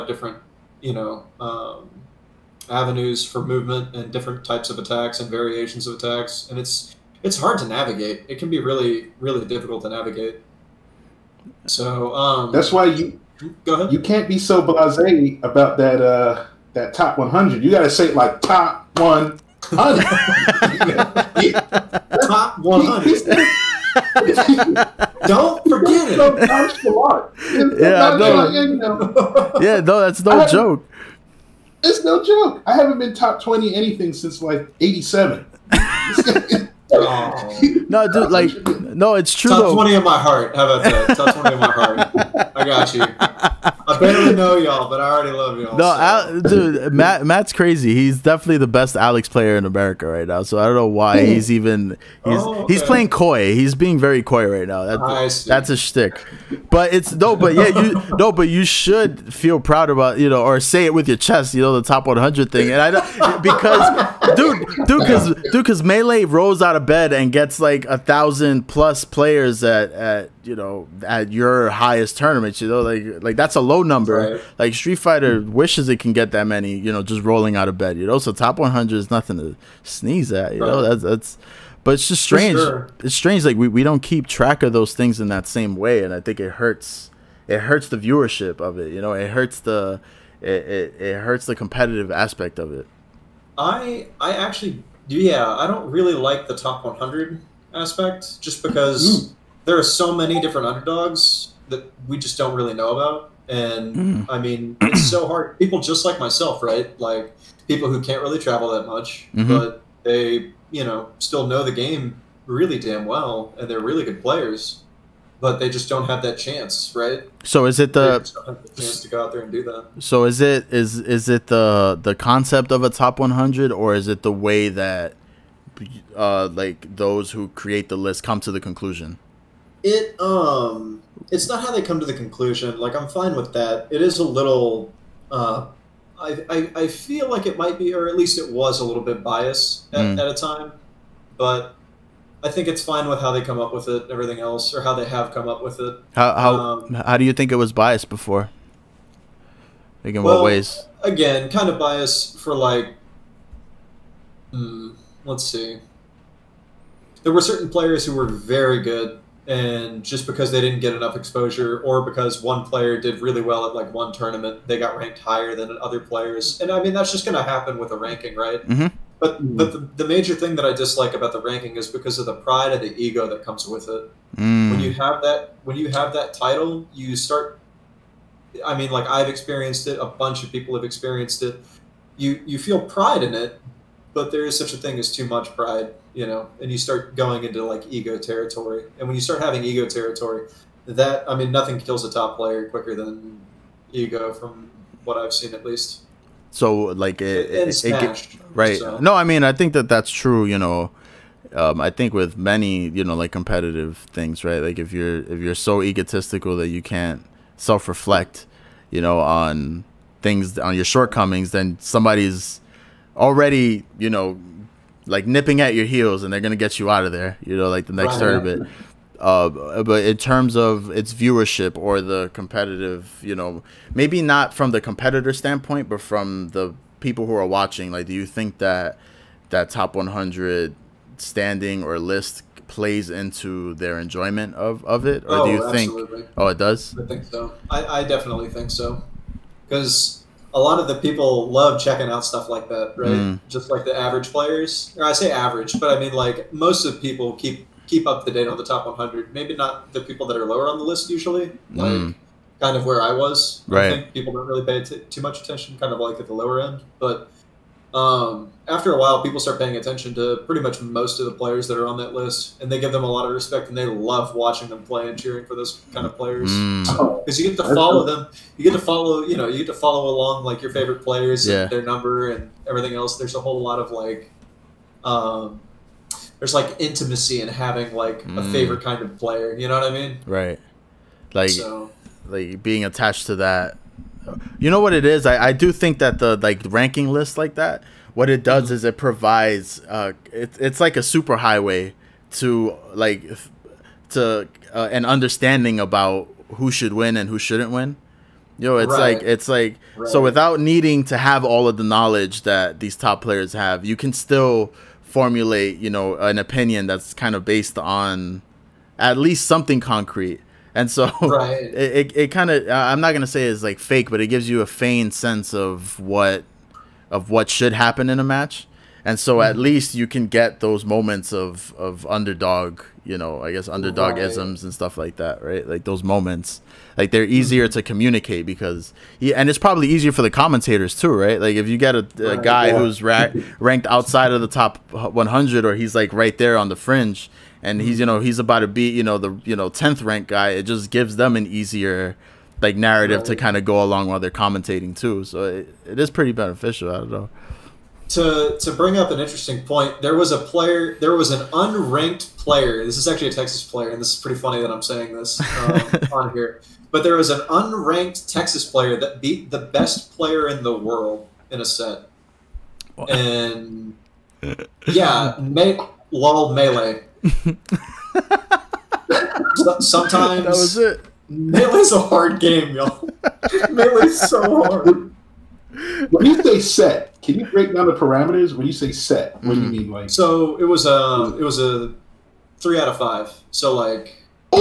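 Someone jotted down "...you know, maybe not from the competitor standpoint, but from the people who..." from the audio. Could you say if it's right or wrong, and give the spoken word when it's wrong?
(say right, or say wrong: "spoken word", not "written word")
right.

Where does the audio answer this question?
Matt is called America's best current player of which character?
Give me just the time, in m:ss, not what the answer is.
0:48.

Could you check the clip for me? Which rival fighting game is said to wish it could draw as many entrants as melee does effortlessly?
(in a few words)
Street Fighter.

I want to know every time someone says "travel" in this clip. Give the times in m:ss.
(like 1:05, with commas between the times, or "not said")
1:48.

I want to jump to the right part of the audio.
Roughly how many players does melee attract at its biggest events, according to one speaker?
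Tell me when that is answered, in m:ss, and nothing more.
1:07.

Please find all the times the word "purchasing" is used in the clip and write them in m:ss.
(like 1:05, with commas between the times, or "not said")
not said.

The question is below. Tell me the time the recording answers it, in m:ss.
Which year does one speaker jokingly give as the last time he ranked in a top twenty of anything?
0:34.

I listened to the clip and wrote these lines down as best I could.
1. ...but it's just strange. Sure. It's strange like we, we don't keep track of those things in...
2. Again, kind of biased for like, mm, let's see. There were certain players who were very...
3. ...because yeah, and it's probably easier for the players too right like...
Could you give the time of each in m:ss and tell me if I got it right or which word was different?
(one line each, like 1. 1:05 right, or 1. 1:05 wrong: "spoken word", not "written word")
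1. 1:21 right
2. 2:31 right
3. 5:28 wrong: "commentators", not "players".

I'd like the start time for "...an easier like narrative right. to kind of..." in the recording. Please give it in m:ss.
5:41.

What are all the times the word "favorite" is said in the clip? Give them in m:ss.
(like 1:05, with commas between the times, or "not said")
4:30, 4:38.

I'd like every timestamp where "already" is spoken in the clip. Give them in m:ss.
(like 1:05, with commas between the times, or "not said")
0:45, 3:33.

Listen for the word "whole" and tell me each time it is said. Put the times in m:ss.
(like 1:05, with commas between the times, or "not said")
4:33.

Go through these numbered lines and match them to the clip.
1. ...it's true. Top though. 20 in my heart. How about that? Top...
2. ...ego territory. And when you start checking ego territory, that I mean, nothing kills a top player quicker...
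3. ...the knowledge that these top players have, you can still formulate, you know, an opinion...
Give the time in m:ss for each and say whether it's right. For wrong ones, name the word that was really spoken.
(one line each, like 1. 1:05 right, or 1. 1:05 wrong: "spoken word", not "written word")
1. 0:39 right
2. 3:07 wrong: "having", not "checking"
3. 5:01 right.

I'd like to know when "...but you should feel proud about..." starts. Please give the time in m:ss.
0:58.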